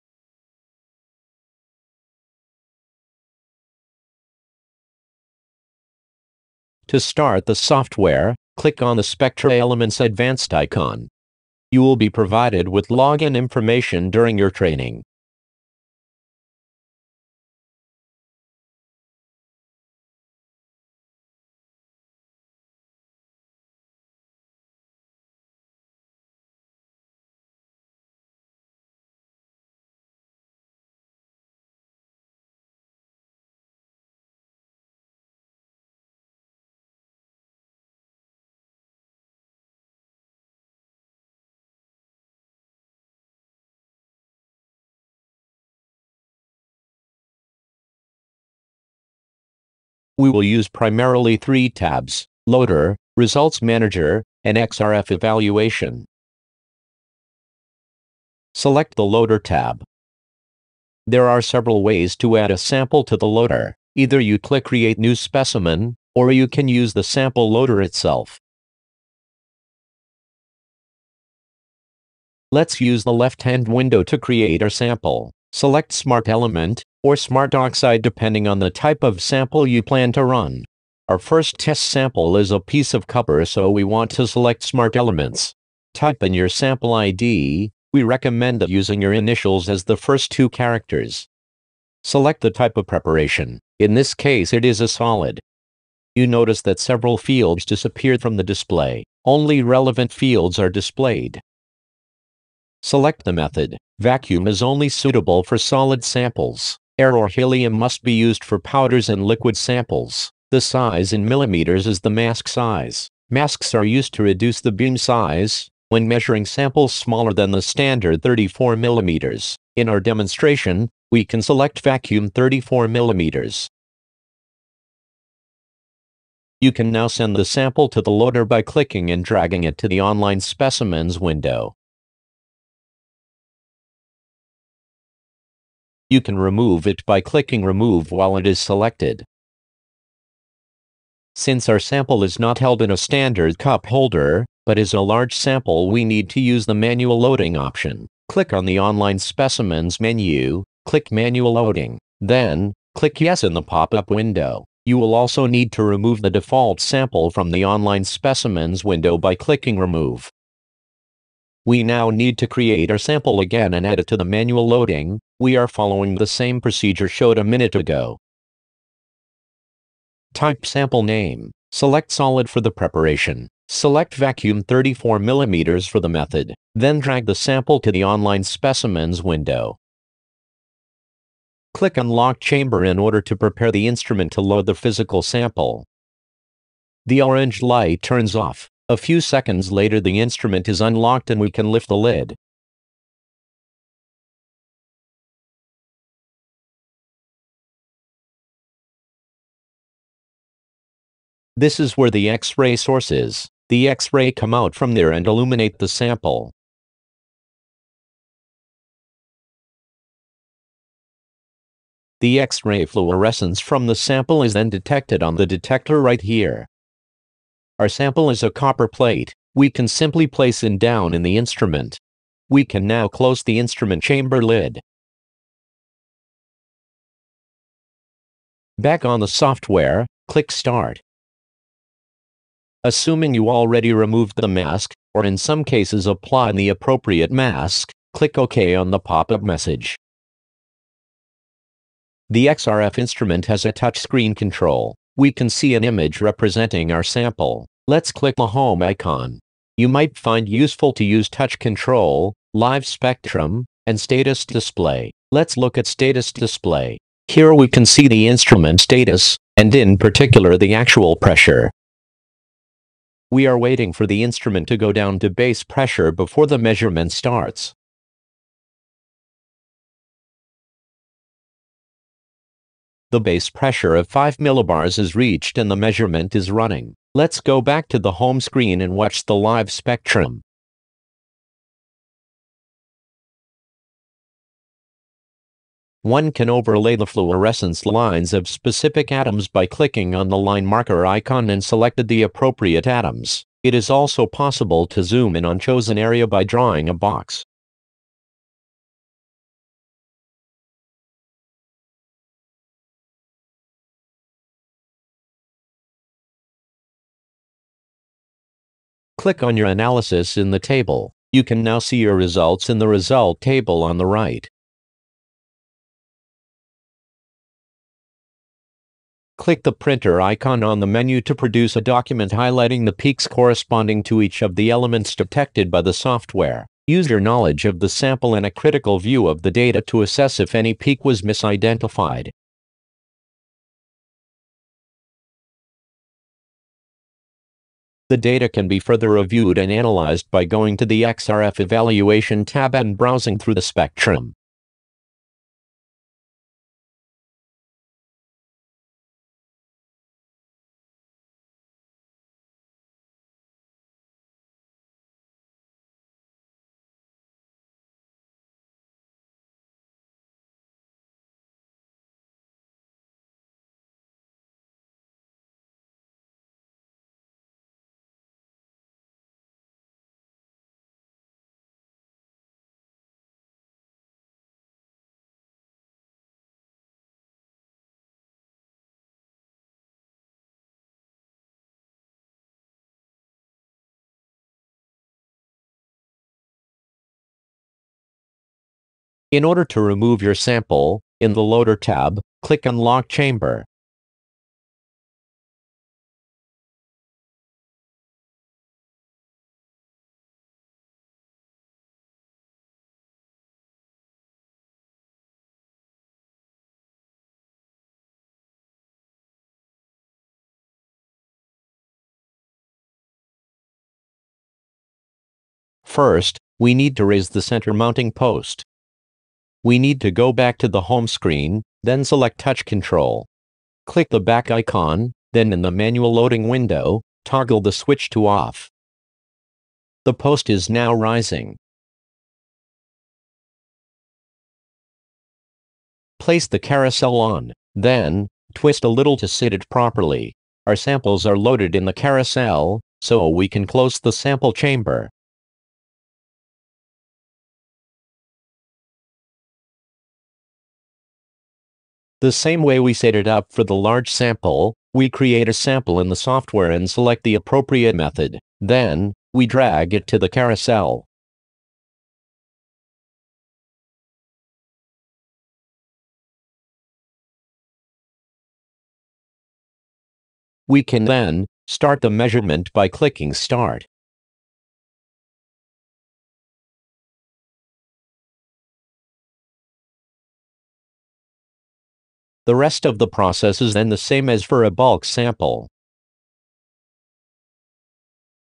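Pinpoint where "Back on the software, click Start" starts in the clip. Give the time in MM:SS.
03:48.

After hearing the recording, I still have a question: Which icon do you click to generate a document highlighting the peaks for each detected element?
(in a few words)
printer icon.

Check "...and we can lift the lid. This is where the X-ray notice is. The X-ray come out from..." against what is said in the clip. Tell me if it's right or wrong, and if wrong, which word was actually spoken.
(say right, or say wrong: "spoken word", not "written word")
wrong: "source", not "notice".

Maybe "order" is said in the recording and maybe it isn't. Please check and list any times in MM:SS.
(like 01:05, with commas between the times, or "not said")
03:02, 06:29.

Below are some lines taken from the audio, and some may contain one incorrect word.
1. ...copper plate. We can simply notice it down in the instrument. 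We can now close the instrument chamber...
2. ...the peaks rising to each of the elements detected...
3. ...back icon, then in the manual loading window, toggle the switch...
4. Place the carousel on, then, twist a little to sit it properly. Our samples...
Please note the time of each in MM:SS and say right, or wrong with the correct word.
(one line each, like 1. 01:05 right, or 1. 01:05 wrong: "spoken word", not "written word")
1. 03:38 wrong: "place", not "notice"
2. 05:22 wrong: "corresponding", not "rising"
3. 07:04 right
4. 07:16 right.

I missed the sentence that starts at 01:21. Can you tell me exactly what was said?
Our first test sample is a piece of copper so we want to select Smart Elements.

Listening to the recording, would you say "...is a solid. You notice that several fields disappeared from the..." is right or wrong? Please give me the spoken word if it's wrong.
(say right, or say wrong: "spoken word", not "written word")
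right.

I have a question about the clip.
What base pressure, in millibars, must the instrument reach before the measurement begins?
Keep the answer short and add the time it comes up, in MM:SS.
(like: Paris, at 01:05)
5, at 04:34.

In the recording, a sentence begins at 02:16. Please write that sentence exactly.
You can remove it by clicking Remove while it is selected.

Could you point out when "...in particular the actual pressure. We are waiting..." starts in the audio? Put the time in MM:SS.
04:19.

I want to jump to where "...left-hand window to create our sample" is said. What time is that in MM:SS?
01:13.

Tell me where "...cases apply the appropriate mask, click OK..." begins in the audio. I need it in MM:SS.
03:55.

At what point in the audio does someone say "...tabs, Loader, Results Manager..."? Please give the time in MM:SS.
00:51.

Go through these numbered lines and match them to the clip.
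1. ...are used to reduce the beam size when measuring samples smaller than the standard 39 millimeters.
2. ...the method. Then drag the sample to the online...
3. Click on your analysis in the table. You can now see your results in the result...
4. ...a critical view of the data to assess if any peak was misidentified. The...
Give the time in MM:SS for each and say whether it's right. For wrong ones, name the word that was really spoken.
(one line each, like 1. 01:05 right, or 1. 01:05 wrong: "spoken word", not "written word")
1. 01:53 wrong: "34", not "39"
2. 02:55 right
3. 05:09 right
4. 05:28 right.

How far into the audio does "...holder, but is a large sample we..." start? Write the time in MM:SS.
02:23.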